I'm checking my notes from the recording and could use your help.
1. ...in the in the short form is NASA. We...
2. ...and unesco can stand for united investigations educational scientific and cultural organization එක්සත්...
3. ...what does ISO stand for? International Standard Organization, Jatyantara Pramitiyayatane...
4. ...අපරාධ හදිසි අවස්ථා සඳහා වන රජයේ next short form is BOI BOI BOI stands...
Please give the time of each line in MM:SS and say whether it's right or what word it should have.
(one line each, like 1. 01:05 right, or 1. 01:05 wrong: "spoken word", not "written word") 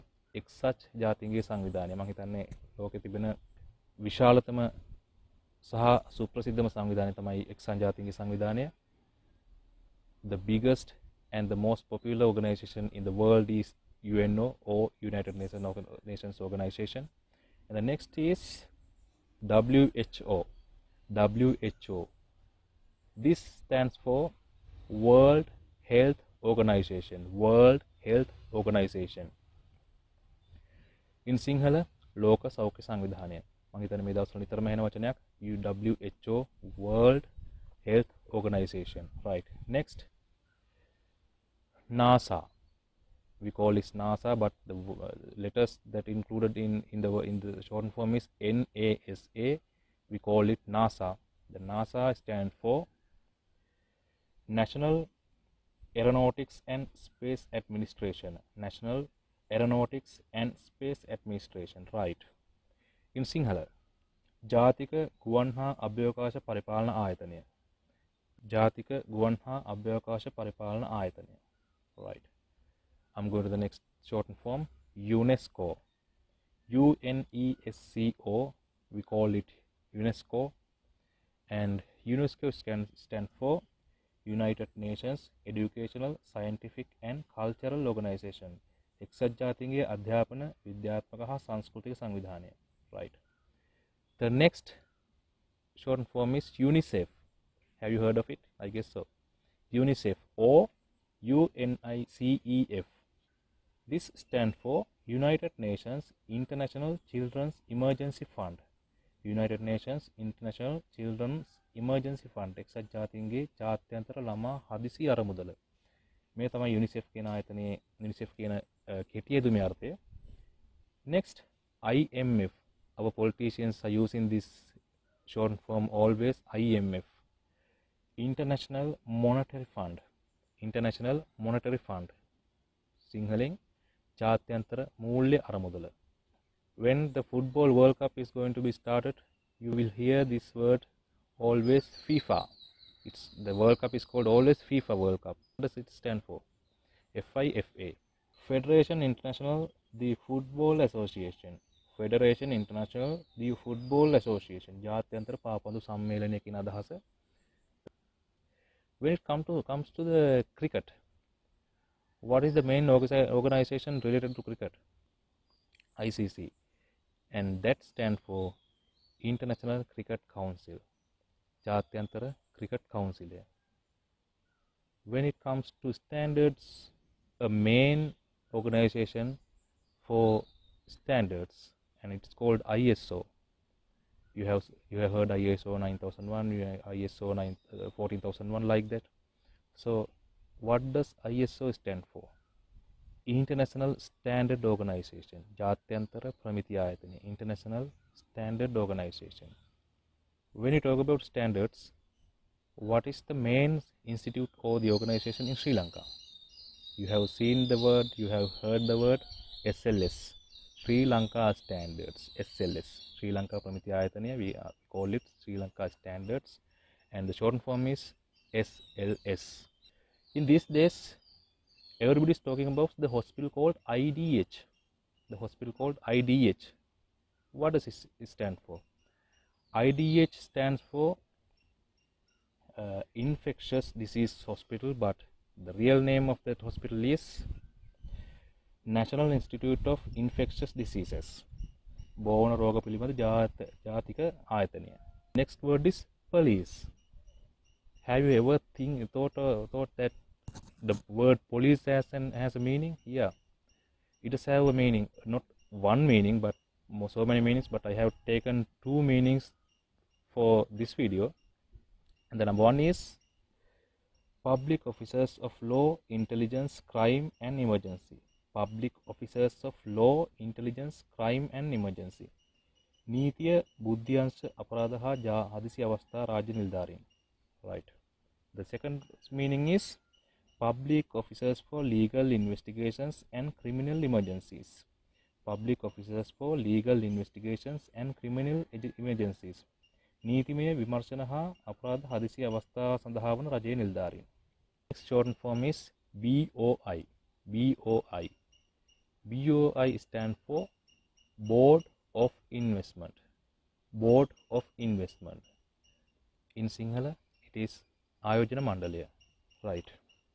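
1. 00:46 right
2. 01:21 wrong: "nations", not "investigations"
3. 03:10 right
4. 04:51 right.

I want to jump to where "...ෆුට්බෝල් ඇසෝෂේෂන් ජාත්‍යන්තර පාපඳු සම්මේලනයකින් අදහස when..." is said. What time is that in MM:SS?
02:33.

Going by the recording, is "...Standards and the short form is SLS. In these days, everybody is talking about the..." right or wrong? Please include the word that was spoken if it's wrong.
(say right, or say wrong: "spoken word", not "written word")
right.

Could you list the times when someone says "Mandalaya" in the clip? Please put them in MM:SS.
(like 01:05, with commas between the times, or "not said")
05:08.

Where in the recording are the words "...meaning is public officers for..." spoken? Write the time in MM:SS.
04:39.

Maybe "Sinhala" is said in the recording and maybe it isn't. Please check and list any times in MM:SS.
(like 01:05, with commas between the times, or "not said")
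00:31, 01:03, 05:06.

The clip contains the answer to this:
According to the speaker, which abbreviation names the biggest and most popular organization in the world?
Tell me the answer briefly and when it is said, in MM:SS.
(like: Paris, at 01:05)
UNO, at 00:14.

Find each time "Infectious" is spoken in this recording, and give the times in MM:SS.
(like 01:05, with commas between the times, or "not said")
03:53, 04:00.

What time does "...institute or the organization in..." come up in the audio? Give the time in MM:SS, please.
03:24.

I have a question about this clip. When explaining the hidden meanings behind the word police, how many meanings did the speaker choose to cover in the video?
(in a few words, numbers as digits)
2.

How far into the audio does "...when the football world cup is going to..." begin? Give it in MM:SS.
02:16.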